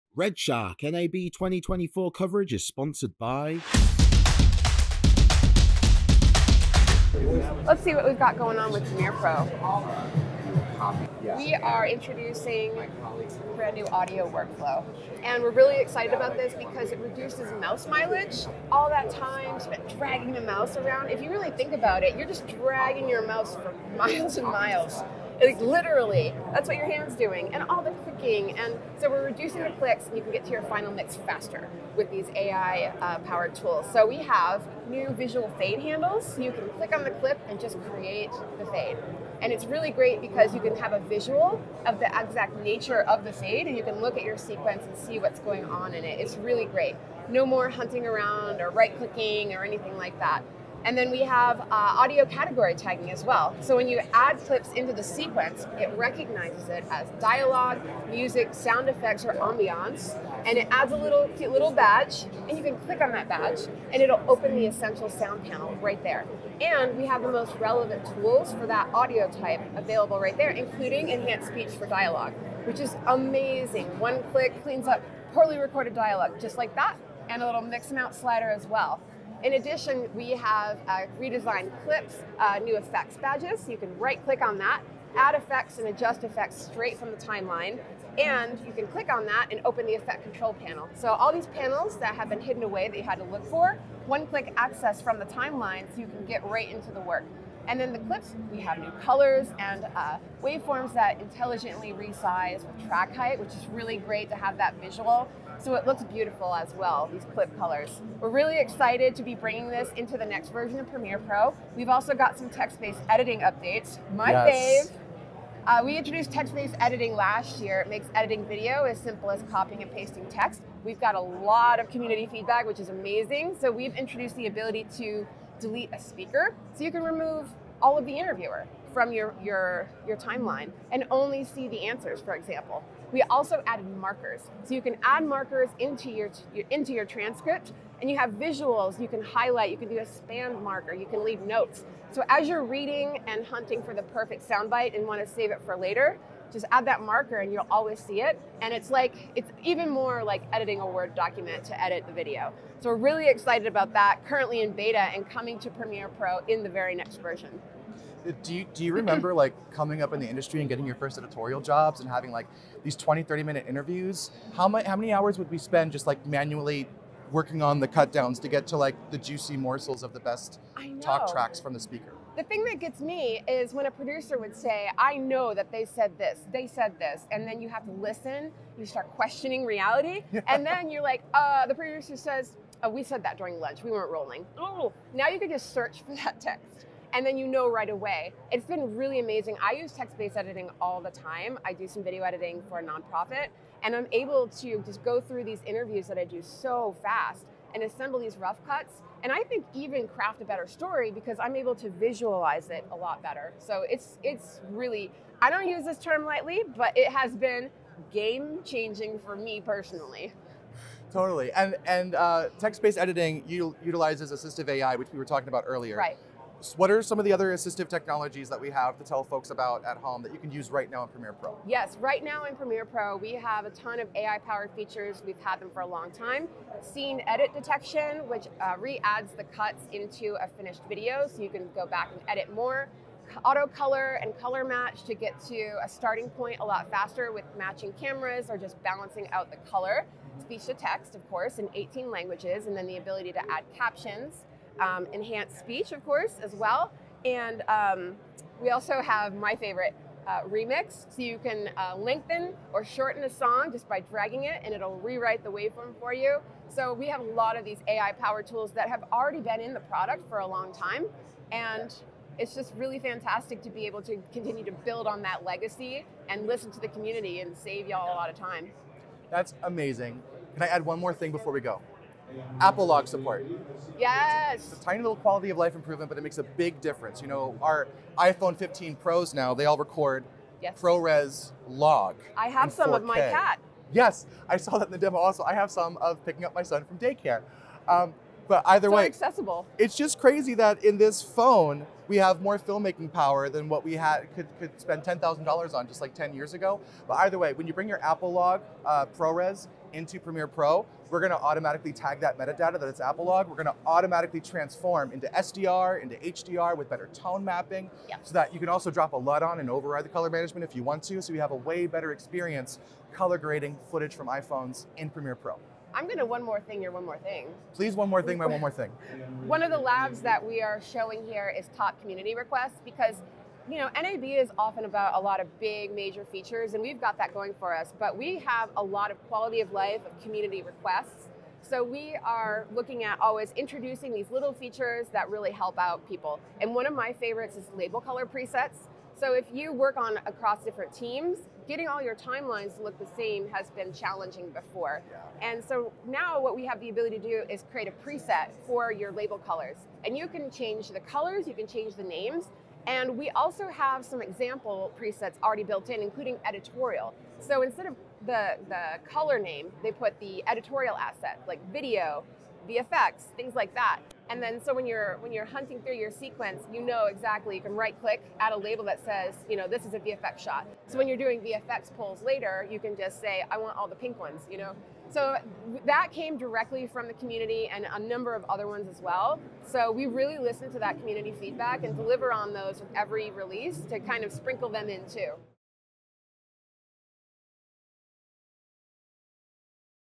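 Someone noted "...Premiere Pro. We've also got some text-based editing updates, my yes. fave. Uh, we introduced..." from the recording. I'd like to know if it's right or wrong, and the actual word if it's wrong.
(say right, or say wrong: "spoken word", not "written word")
right.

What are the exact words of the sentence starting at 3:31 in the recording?
Totally, and and uh, text-based editing utilizes assistive AI, which we were talking about earlier.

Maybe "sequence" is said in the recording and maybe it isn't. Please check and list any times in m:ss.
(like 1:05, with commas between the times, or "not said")
0:44, 0:55, 6:06.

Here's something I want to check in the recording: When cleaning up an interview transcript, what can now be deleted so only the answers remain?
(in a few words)
a speaker.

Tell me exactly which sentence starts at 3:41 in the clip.
Yes, right now in Premiere Pro, we have a ton of AI-powered features.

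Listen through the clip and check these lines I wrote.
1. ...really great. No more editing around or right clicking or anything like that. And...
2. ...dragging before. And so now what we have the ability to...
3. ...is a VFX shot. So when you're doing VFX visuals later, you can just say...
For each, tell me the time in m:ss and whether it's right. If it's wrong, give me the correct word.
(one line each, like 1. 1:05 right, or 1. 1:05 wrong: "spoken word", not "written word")
1. 0:46 wrong: "hunting", not "editing"
2. 5:43 wrong: "challenging", not "dragging"
3. 6:09 wrong: "pulls", not "visuals".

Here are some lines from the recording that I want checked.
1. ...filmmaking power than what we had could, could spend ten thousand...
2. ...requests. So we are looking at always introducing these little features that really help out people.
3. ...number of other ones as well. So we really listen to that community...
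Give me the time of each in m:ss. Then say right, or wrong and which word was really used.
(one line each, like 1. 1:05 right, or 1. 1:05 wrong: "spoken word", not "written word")
1. 4:52 right
2. 5:30 right
3. 6:17 right.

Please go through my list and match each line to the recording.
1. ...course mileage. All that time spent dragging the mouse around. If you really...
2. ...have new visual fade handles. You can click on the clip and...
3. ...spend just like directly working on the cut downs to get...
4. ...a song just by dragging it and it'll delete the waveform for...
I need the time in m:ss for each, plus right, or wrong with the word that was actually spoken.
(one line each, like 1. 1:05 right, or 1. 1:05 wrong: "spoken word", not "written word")
1. 0:17 wrong: "mouse", not "course"
2. 0:34 right
3. 2:45 wrong: "manually", not "directly"
4. 4:13 wrong: "rewrite", not "delete".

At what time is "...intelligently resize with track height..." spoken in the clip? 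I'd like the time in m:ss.
1:41.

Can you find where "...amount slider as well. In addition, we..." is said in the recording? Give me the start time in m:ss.
1:17.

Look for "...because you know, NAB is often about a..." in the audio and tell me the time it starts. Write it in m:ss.
5:22.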